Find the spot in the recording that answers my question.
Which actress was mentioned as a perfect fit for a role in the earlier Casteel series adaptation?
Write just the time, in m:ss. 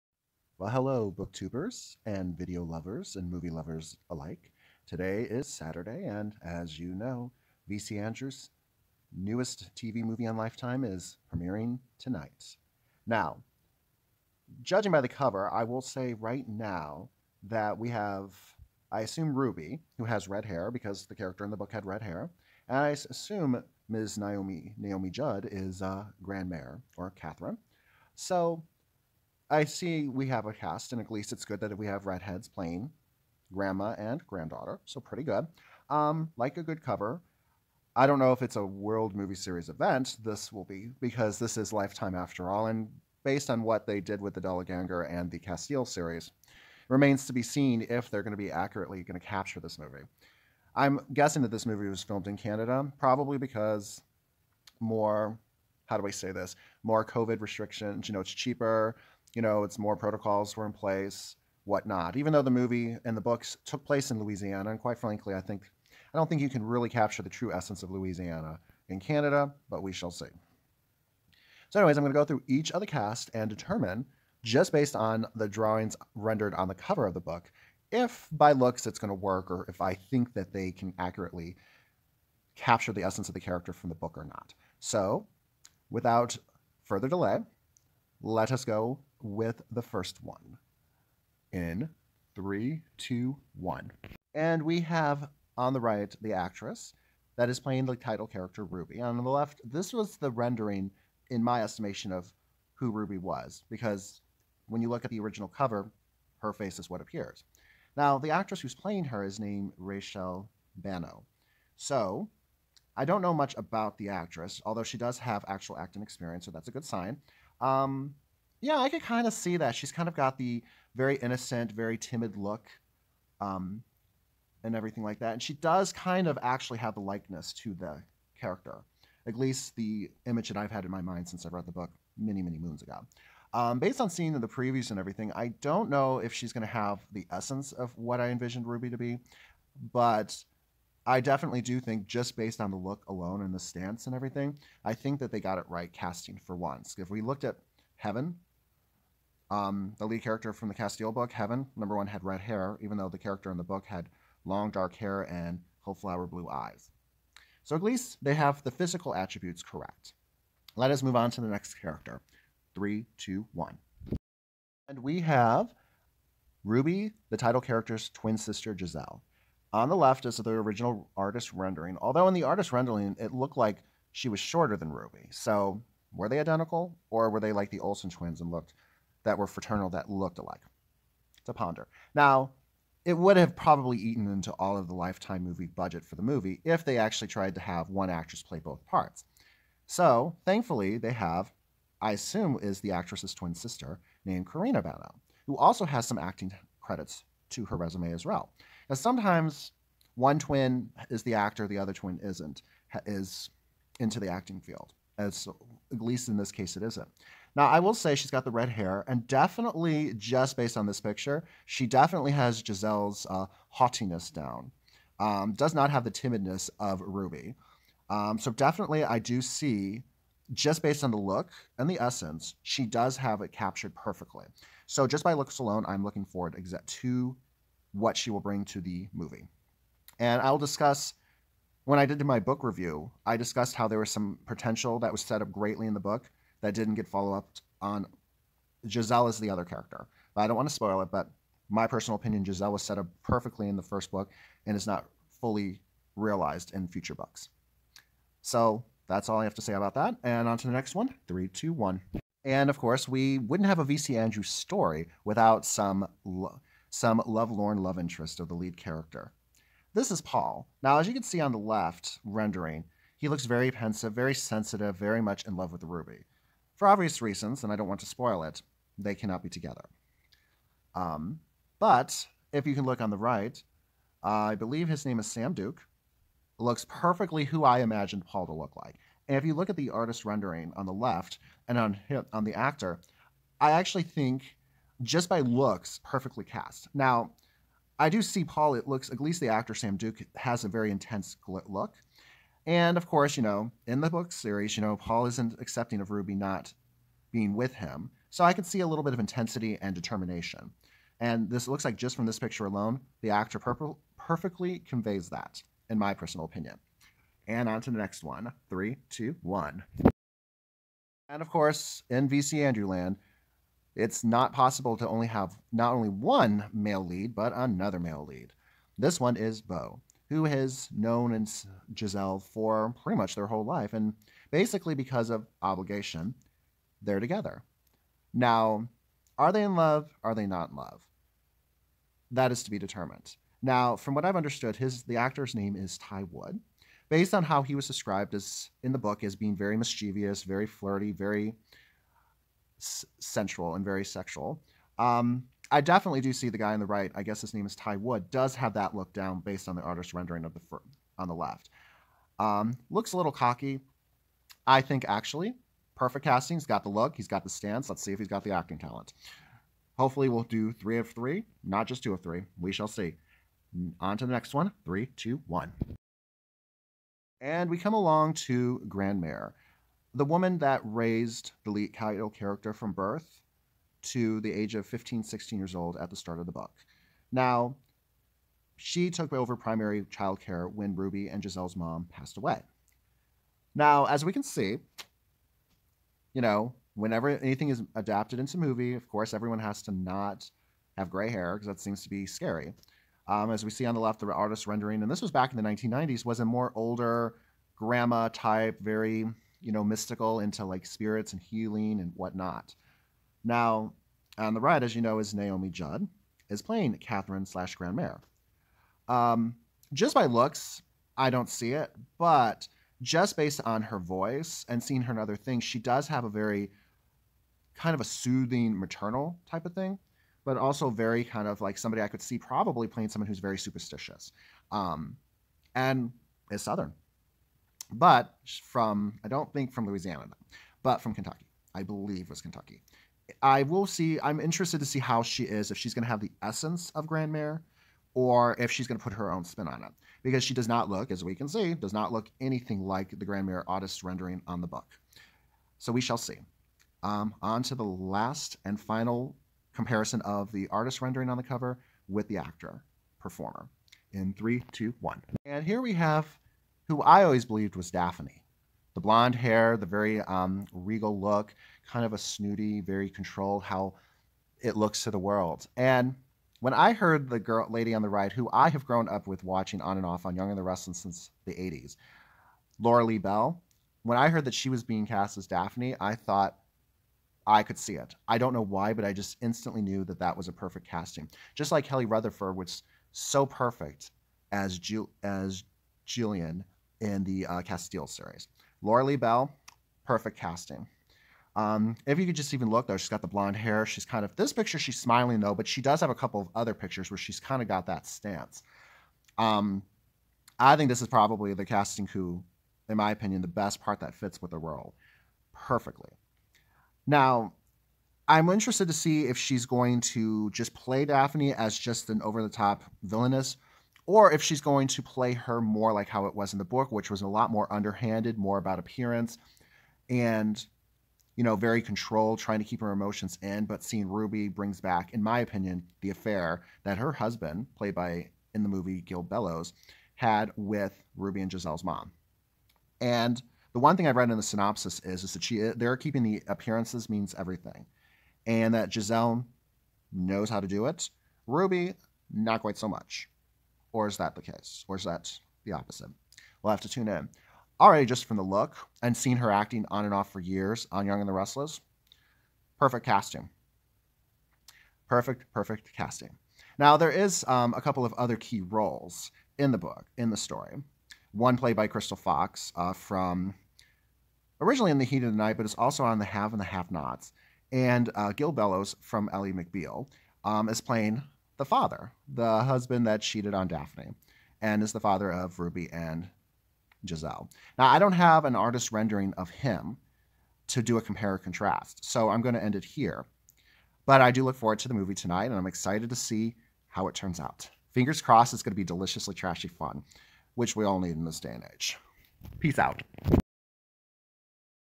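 8:01.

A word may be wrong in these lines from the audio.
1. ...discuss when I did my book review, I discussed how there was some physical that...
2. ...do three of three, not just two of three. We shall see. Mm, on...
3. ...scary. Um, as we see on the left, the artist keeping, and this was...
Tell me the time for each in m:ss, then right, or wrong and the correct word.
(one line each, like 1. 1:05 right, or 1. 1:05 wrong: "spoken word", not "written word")
1. 3:50 wrong: "potential", not "physical"
2. 6:00 right
3. 6:32 wrong: "rendering", not "keeping".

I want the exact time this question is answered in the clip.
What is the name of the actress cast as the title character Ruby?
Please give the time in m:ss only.
1:49.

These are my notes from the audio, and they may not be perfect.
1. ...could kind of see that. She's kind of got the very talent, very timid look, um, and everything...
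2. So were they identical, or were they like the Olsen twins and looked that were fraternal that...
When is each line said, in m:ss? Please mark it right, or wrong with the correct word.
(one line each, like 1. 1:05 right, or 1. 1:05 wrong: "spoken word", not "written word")
1. 1:58 wrong: "innocent", not "talent"
2. 2:55 right.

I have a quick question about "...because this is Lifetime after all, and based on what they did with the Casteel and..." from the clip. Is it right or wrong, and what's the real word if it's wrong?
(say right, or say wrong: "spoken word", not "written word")
wrong: "Dollanganger", not "Casteel".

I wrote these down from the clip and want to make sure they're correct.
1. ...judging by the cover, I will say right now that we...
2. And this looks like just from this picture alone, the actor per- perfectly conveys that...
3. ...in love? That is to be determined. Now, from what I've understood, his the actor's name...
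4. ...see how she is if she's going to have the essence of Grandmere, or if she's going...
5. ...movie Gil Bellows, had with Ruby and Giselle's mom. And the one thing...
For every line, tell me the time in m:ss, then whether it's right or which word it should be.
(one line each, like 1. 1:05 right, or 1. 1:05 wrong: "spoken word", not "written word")
1. 0:14 right
2. 5:01 right
3. 5:30 right
4. 7:14 right
5. 8:48 right.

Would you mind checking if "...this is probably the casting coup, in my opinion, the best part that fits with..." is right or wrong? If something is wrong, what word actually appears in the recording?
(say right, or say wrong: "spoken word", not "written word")
right.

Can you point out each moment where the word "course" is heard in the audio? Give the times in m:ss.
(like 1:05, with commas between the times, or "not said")
4:12, 4:53, 5:11, 6:29.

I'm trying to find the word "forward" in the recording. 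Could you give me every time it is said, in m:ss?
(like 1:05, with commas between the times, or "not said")
3:46, 9:44.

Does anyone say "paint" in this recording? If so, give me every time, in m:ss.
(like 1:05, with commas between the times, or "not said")
not said.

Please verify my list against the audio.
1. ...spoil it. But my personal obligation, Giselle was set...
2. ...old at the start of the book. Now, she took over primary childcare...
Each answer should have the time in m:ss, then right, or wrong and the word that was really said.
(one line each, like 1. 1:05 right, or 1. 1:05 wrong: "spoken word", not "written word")
1. 4:00 wrong: "opinion", not "obligation"
2. 6:15 right.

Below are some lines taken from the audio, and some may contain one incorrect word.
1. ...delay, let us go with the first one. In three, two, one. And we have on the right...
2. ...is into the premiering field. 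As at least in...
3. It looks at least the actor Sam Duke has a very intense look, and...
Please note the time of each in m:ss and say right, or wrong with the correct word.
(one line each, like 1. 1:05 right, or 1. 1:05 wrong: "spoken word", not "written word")
1. 1:27 right
2. 3:23 wrong: "acting", not "premiering"
3. 4:48 right.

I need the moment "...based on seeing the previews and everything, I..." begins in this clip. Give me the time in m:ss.
2:13.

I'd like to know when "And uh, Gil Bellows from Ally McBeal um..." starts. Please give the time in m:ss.
9:27.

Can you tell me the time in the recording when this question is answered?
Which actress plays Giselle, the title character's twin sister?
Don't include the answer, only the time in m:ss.
3:14.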